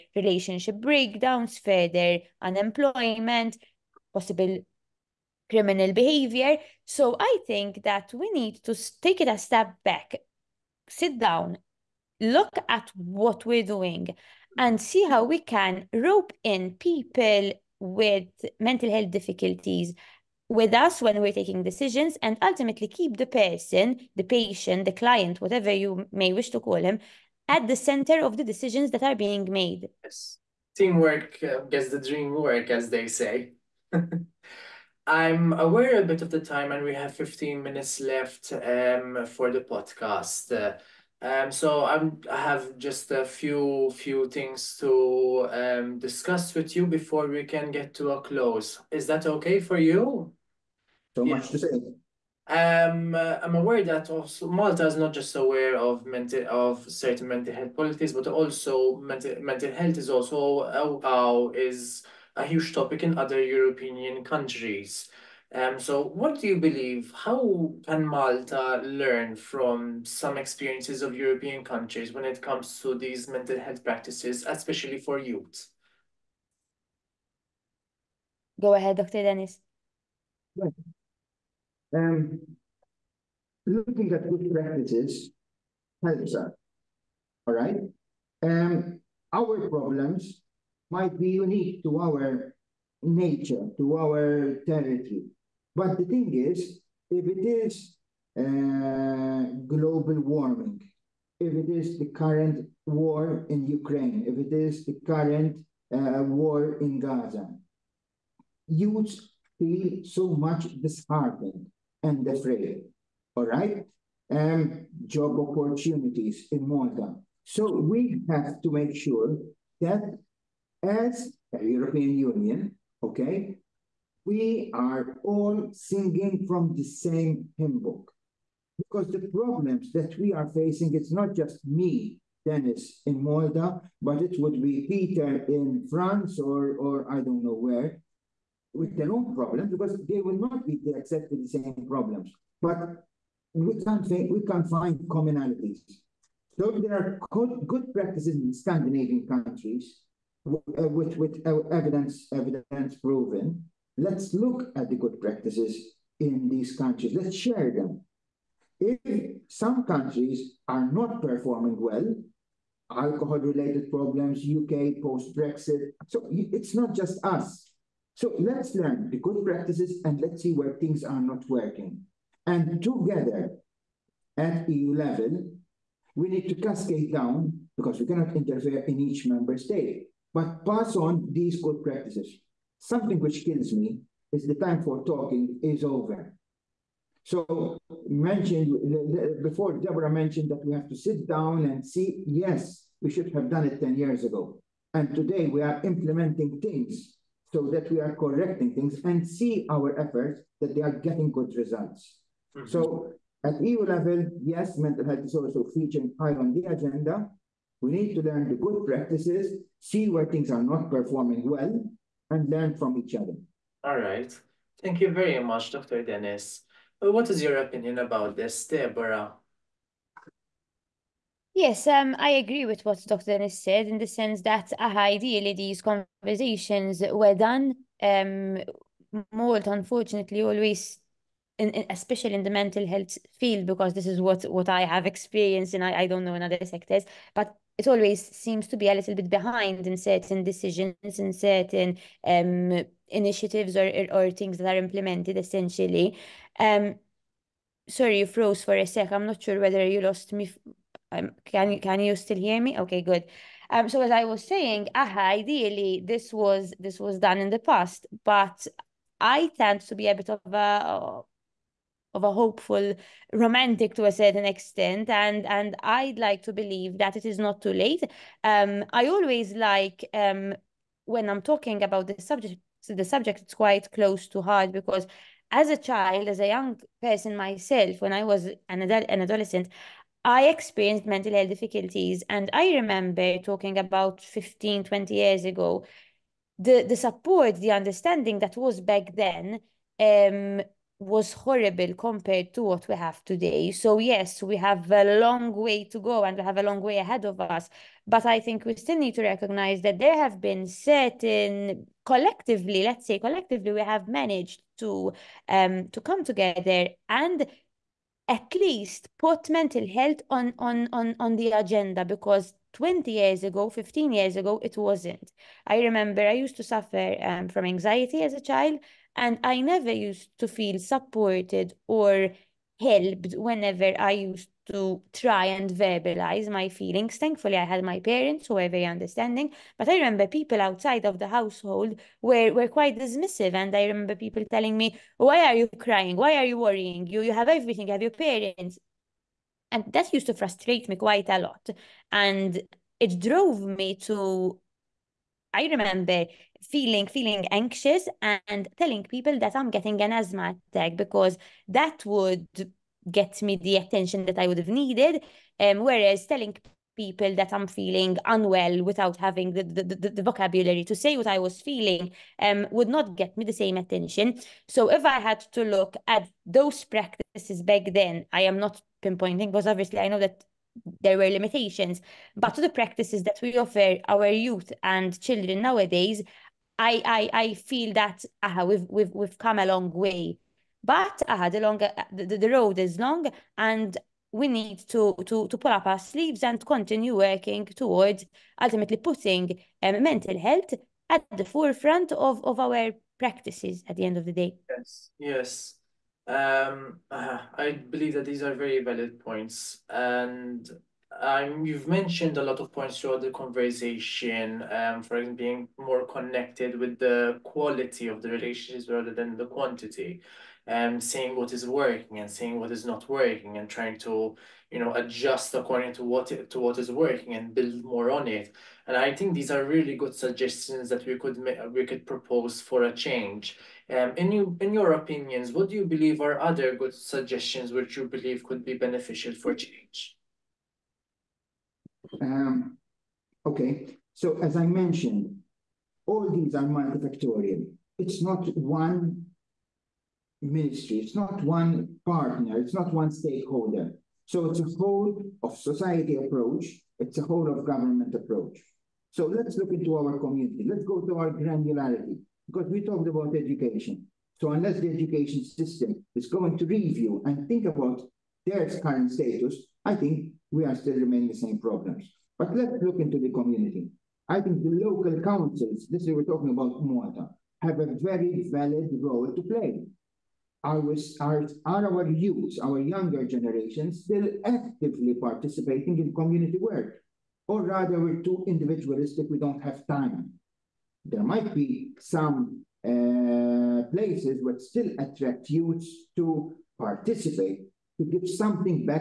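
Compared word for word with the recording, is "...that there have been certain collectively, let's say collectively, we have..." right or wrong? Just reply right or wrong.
right.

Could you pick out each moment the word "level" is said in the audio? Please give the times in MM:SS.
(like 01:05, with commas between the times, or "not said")
02:54, 03:23.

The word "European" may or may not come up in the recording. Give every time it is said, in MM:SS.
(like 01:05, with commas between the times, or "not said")
01:03, 01:11, 02:01.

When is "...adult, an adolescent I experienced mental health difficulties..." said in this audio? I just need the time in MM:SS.
04:38.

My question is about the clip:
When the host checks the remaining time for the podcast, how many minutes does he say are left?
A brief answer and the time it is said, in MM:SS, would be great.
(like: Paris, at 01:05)
15 minutes, at 00:37.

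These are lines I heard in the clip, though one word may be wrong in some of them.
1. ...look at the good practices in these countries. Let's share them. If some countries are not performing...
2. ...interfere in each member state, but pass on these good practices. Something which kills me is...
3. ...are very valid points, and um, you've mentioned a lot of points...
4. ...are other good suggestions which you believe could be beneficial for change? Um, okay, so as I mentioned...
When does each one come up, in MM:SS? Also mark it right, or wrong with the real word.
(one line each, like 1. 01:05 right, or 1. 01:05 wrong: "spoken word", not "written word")
1. 02:34 right
2. 02:58 right
3. 06:38 right
4. 07:06 right.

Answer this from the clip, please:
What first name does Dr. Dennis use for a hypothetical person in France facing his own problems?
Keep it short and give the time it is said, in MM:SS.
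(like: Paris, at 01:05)
Peter, at 02:14.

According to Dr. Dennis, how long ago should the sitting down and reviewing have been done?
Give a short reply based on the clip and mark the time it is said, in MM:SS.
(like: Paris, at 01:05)
10 years ago, at 03:13.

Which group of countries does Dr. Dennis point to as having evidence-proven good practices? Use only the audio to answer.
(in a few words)
Scandinavian countries.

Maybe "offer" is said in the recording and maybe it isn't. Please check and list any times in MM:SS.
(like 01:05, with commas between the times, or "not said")
06:13.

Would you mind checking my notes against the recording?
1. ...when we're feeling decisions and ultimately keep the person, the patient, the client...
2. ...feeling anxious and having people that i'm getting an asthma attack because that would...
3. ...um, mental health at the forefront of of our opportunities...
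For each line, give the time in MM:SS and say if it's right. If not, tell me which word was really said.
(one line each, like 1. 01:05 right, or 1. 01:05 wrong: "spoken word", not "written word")
1. 00:21 wrong: "taking", not "feeling"
2. 05:47 wrong: "telling", not "having"
3. 06:29 wrong: "practices", not "opportunities".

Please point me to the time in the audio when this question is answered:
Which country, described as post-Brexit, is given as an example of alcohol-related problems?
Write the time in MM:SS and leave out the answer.
02:44.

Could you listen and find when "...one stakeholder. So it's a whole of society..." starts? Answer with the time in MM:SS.
07:22.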